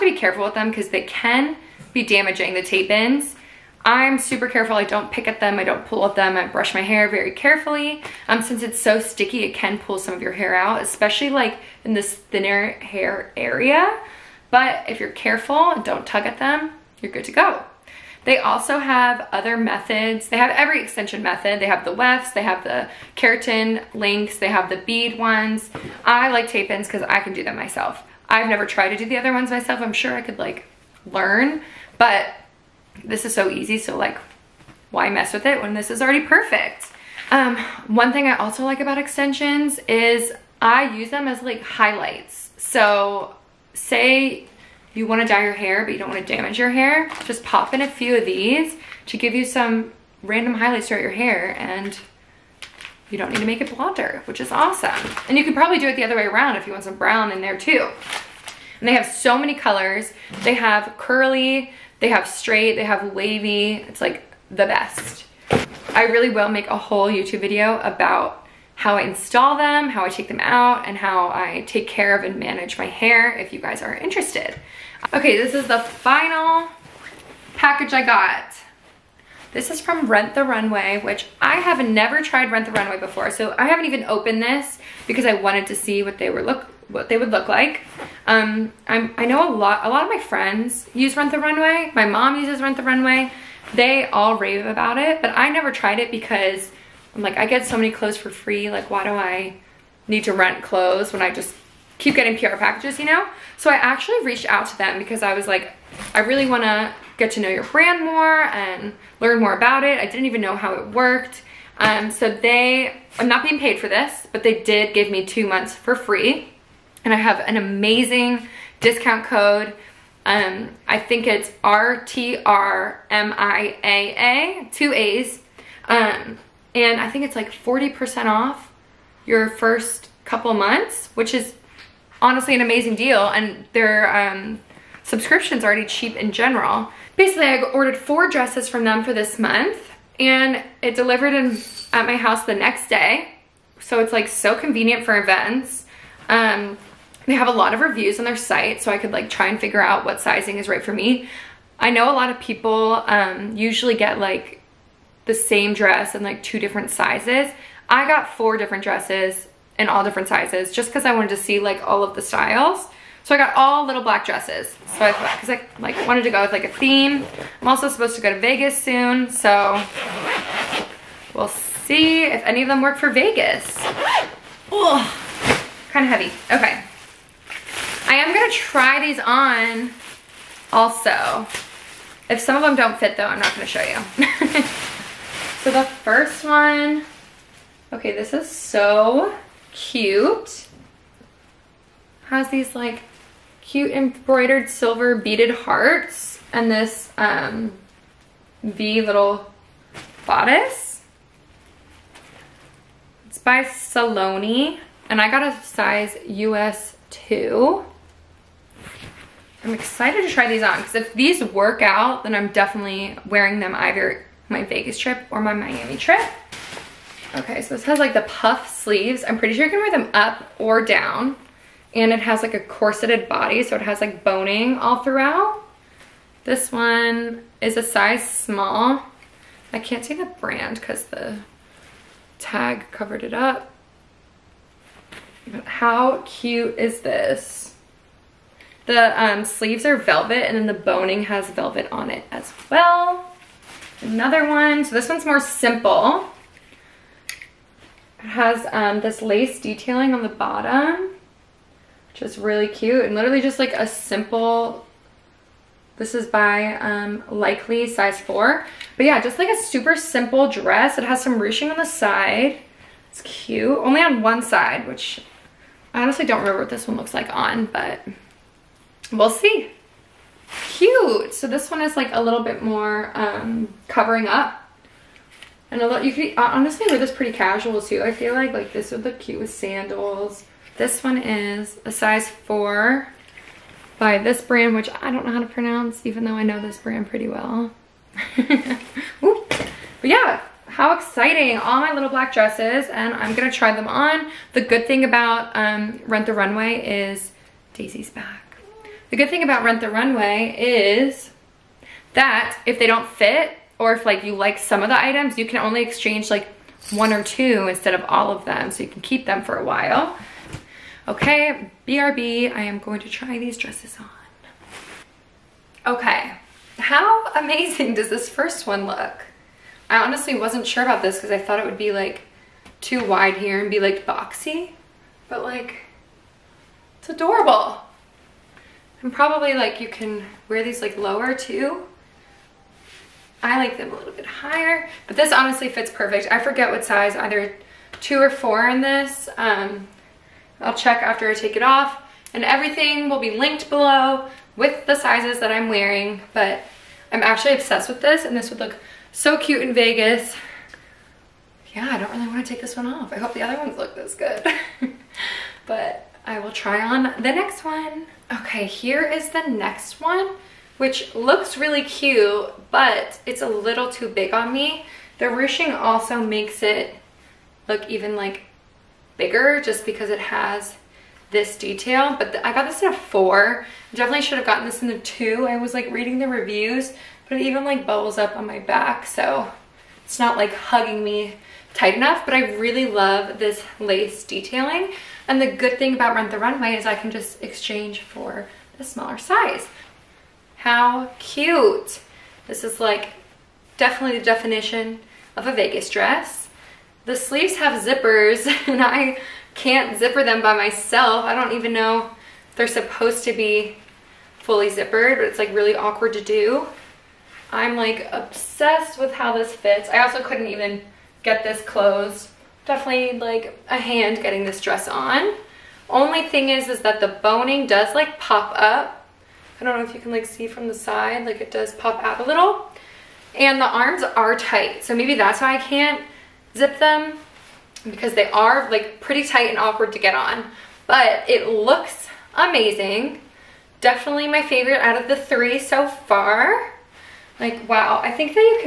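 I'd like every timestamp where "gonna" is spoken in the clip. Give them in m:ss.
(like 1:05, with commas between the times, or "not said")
2:58, 3:03, 4:53.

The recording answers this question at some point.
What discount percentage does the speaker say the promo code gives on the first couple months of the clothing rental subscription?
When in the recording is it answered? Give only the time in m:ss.
2:07.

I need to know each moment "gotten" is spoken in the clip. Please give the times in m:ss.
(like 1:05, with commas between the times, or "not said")
6:14.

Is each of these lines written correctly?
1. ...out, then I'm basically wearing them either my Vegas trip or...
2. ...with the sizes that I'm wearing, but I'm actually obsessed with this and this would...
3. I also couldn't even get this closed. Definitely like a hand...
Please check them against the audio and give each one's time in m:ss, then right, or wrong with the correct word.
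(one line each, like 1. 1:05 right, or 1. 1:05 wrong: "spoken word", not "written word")
1. 3:31 wrong: "definitely", not "basically"
2. 5:44 right
3. 6:49 right.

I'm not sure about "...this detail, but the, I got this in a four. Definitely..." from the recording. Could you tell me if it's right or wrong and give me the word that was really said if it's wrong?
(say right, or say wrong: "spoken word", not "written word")
right.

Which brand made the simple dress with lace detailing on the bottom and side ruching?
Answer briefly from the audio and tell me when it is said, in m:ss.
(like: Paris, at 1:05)
Likely, at 4:17.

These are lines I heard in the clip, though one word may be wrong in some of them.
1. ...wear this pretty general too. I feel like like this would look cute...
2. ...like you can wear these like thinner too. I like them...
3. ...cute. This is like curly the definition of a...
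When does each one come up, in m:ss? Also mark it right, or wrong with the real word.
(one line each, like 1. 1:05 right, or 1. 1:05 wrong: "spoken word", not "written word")
1. 4:36 wrong: "casual", not "general"
2. 5:29 wrong: "lower", not "thinner"
3. 6:31 wrong: "definitely", not "curly".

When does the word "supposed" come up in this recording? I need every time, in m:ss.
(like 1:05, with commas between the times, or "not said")
2:47, 6:42.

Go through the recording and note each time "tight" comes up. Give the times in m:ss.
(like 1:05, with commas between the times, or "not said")
6:21, 7:04, 7:09.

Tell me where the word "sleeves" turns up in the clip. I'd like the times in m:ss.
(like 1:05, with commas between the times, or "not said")
3:38, 3:59, 6:37.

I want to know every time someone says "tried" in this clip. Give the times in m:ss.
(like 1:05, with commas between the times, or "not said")
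0:28, 1:22, 1:35.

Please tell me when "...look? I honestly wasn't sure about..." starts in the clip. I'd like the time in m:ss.
5:18.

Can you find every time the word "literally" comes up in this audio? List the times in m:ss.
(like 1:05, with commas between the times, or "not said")
4:13.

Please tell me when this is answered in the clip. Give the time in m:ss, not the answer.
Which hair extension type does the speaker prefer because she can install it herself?
0:26.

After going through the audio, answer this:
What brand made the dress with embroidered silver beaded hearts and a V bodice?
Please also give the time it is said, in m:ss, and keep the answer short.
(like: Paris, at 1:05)
Saloni, at 3:23.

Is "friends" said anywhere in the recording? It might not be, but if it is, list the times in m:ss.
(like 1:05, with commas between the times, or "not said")
1:30.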